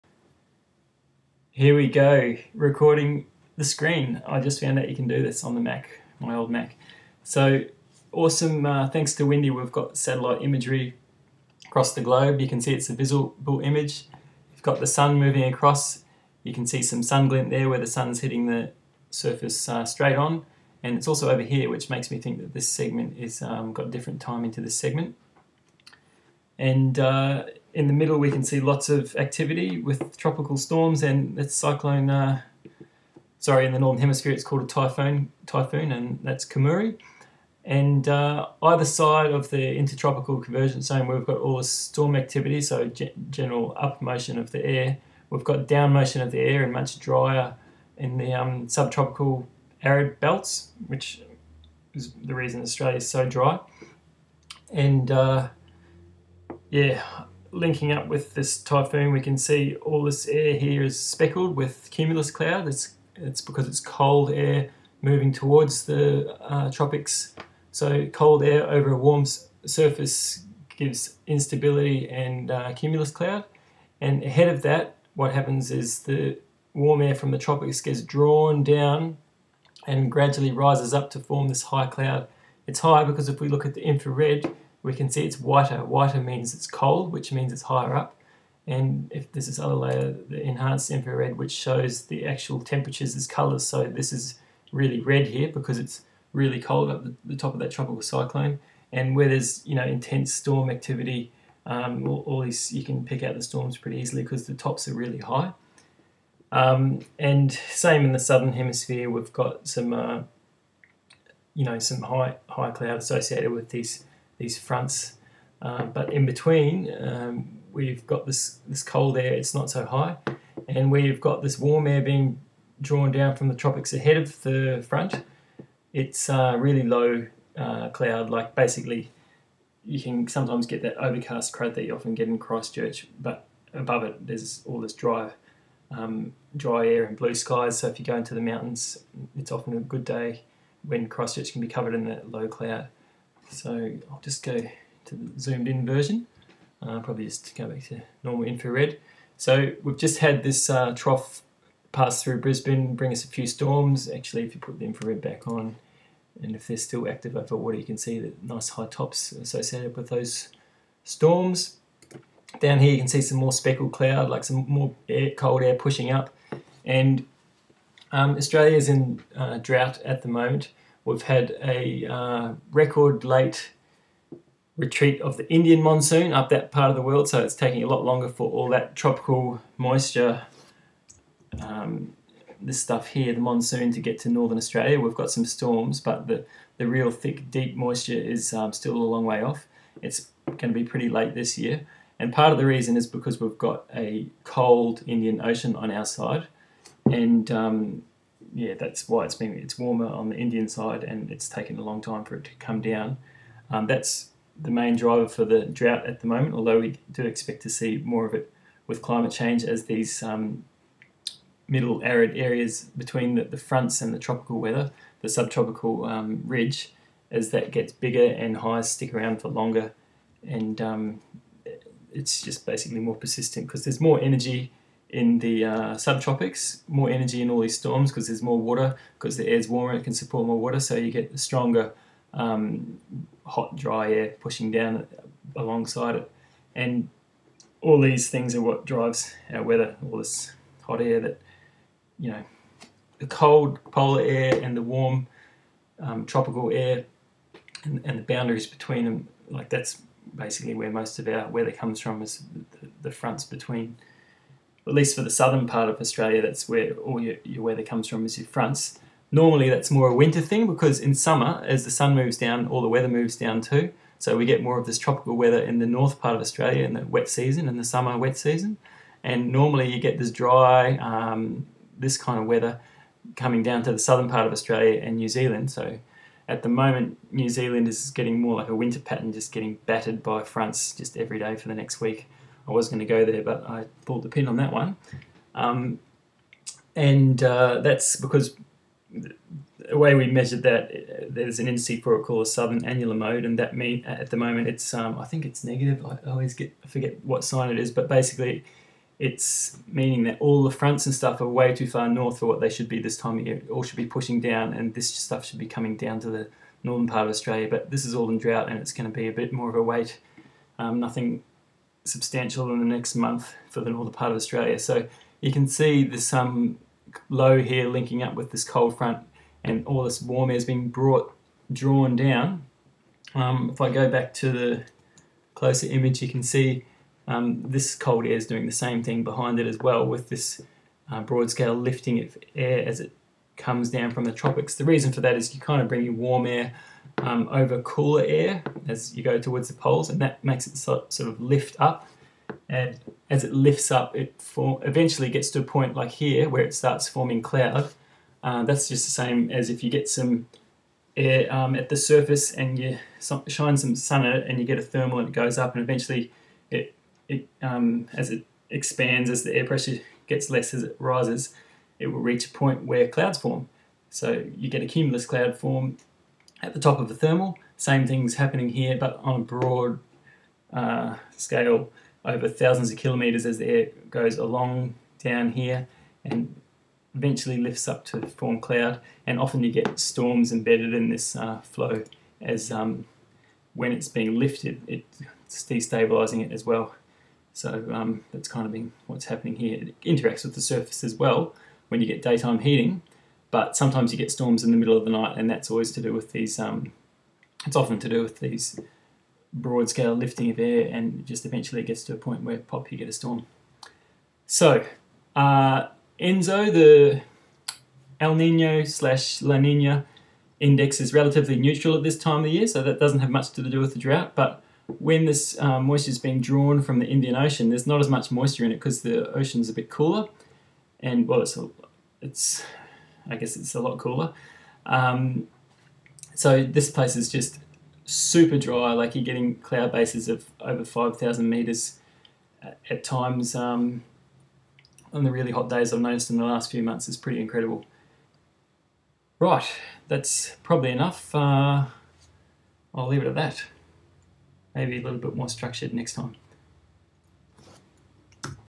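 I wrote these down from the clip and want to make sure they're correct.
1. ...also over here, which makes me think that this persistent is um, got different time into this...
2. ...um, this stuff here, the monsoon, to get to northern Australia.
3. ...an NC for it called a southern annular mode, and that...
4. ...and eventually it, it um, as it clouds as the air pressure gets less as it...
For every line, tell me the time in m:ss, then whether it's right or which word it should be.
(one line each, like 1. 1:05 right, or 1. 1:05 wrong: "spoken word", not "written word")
1. 0:21 wrong: "segment", not "persistent"
2. 3:01 right
3. 4:51 right
4. 5:55 wrong: "expands", not "clouds".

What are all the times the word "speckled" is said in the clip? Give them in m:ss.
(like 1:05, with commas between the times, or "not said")
1:00, 2:43.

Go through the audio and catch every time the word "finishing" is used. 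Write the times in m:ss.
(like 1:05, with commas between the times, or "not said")
not said.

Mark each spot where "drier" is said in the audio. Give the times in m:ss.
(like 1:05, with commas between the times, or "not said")
0:46.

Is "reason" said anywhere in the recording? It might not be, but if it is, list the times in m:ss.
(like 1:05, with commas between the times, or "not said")
0:52, 3:12, 5:34.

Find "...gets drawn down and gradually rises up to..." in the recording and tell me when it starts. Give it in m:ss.
1:17.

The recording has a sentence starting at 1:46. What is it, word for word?
Um, and same in the southern hemisphere, we've got some uh, you know some high high cloud associated with these these fronts.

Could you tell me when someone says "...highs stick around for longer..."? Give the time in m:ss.
3:38.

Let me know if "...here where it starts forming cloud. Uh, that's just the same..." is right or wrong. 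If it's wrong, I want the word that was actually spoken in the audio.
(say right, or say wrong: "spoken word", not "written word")
right.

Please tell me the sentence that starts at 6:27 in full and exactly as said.
So um, that's kind of been what's happening here.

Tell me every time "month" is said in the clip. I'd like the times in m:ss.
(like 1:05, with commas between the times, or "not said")
5:13, 7:16.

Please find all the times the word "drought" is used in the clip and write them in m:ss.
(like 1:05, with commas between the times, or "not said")
2:49, 3:25, 5:08, 6:53.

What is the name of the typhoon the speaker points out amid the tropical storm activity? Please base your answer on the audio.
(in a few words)
Kammuri.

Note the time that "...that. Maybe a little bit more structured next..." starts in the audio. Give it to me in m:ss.
7:23.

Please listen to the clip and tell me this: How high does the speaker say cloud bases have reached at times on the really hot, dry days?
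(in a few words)
Over 5000 meters.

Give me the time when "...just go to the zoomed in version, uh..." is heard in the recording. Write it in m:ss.
2:24.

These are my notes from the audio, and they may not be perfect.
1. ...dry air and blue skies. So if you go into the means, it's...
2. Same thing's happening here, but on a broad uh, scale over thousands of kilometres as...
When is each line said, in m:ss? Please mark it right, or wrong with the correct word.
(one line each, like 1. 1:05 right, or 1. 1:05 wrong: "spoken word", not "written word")
1. 2:16 wrong: "mountains", not "means"
2. 6:07 right.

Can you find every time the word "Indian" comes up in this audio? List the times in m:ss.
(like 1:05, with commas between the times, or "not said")
2:55, 3:15, 3:20, 6:57.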